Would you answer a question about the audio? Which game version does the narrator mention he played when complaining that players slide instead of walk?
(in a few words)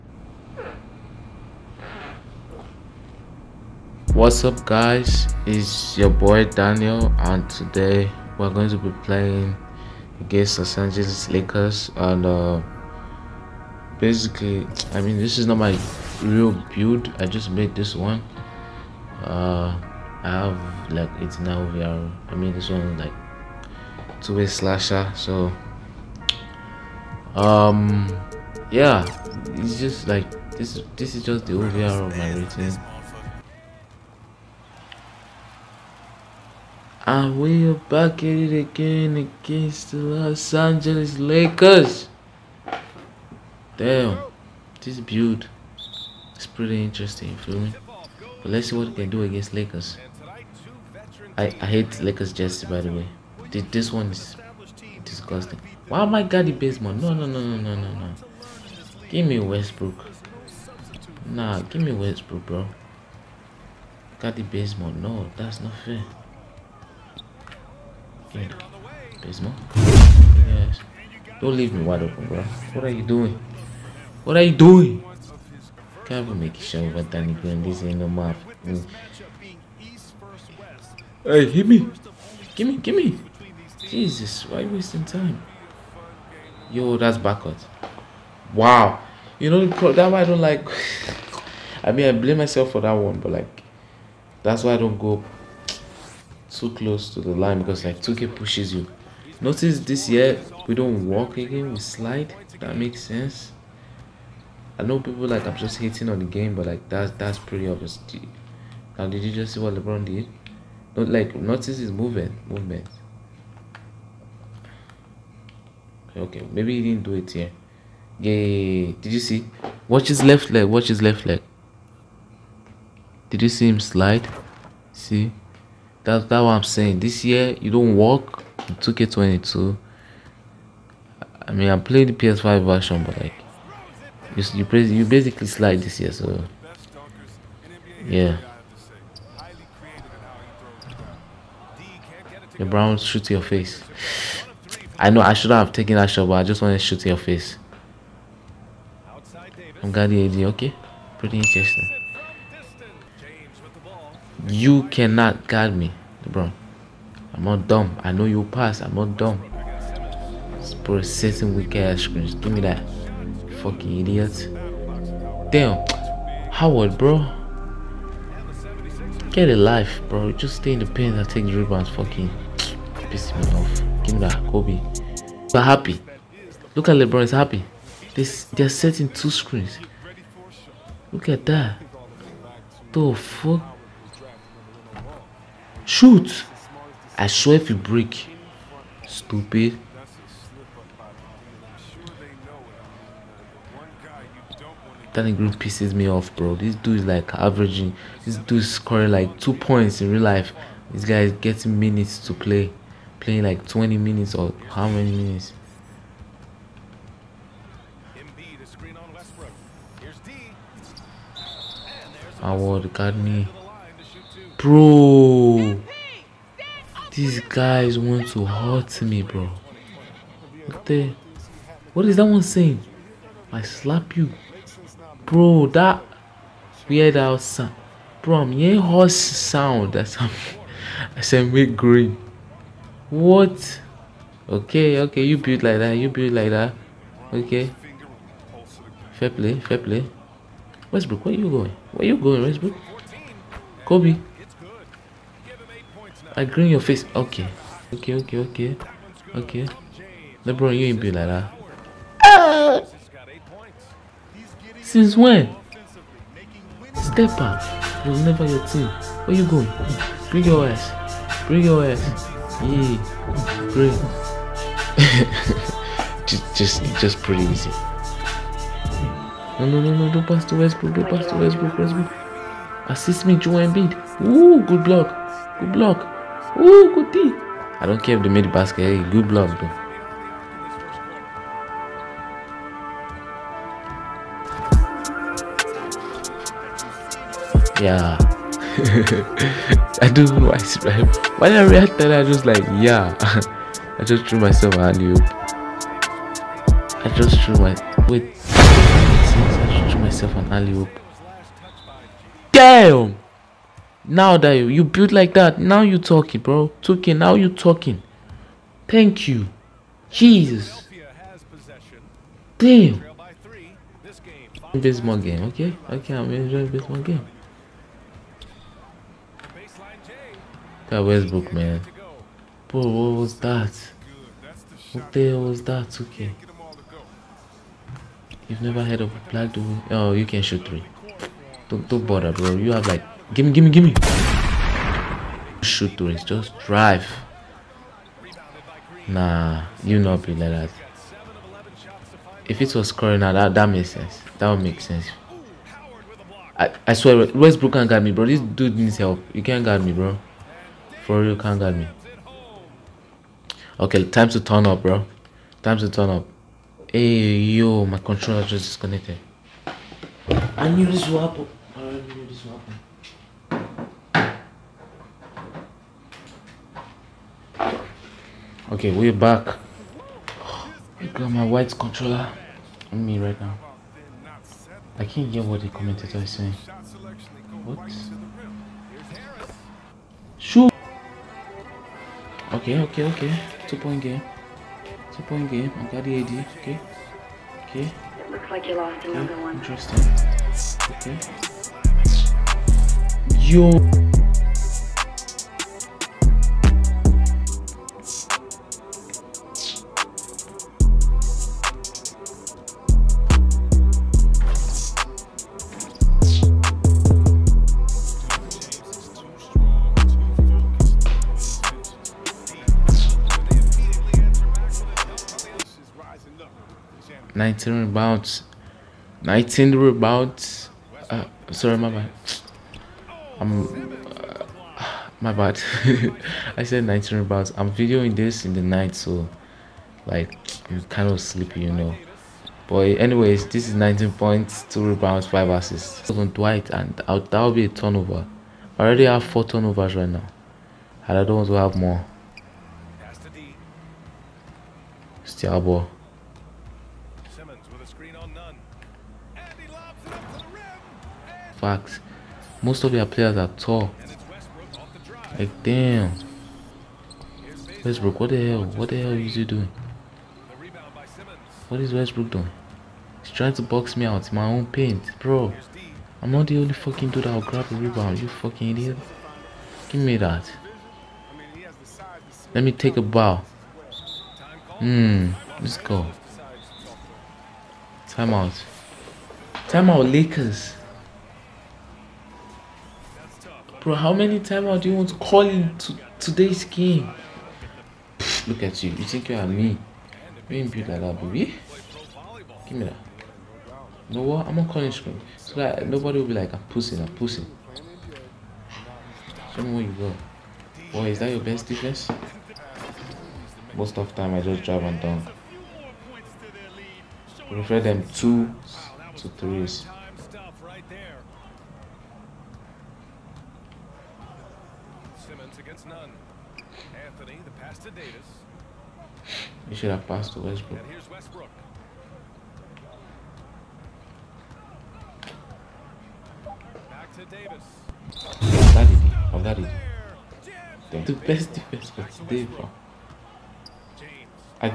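PS5.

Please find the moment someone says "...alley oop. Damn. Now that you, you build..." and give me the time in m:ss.
5:00.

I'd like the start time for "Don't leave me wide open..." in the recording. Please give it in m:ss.
1:11.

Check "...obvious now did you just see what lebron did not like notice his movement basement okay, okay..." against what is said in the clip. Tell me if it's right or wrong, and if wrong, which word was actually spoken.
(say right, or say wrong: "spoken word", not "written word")
wrong: "movement", not "basement".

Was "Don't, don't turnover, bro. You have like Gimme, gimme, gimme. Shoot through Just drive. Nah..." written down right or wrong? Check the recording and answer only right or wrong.
wrong.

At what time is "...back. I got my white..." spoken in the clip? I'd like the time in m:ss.
6:09.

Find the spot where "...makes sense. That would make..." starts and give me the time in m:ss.
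5:43.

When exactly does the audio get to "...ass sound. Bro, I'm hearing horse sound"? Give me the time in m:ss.
3:47.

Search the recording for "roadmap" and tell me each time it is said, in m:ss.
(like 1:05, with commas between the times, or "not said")
not said.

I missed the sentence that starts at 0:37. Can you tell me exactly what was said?
I will back at it again against the Los Angeles Lakers.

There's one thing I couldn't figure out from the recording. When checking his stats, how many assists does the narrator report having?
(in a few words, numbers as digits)
5.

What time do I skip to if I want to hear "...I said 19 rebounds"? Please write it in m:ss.
7:06.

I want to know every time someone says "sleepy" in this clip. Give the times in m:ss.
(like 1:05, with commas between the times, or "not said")
7:11.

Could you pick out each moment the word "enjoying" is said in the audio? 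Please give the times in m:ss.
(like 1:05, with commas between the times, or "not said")
5:16.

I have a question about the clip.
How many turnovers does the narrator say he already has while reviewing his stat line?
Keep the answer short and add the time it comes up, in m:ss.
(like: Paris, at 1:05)
4, at 7:19.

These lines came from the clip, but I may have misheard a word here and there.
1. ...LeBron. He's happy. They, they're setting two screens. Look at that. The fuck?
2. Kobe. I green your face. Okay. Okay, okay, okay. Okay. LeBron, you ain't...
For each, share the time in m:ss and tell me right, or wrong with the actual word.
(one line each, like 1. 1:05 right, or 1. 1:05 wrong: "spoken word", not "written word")
1. 2:56 right
2. 4:03 right.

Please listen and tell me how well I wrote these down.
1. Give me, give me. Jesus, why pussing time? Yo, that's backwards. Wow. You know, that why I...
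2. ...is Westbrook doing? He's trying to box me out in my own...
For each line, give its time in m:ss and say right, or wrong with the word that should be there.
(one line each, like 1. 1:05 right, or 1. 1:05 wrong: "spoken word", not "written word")
1. 1:22 wrong: "wasting", not "pussing"
2. 7:41 right.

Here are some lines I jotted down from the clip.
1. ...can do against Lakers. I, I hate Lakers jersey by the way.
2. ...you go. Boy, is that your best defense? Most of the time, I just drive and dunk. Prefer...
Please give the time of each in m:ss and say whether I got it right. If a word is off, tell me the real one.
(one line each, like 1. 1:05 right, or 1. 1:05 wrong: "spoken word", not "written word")
1. 0:48 right
2. 8:19 right.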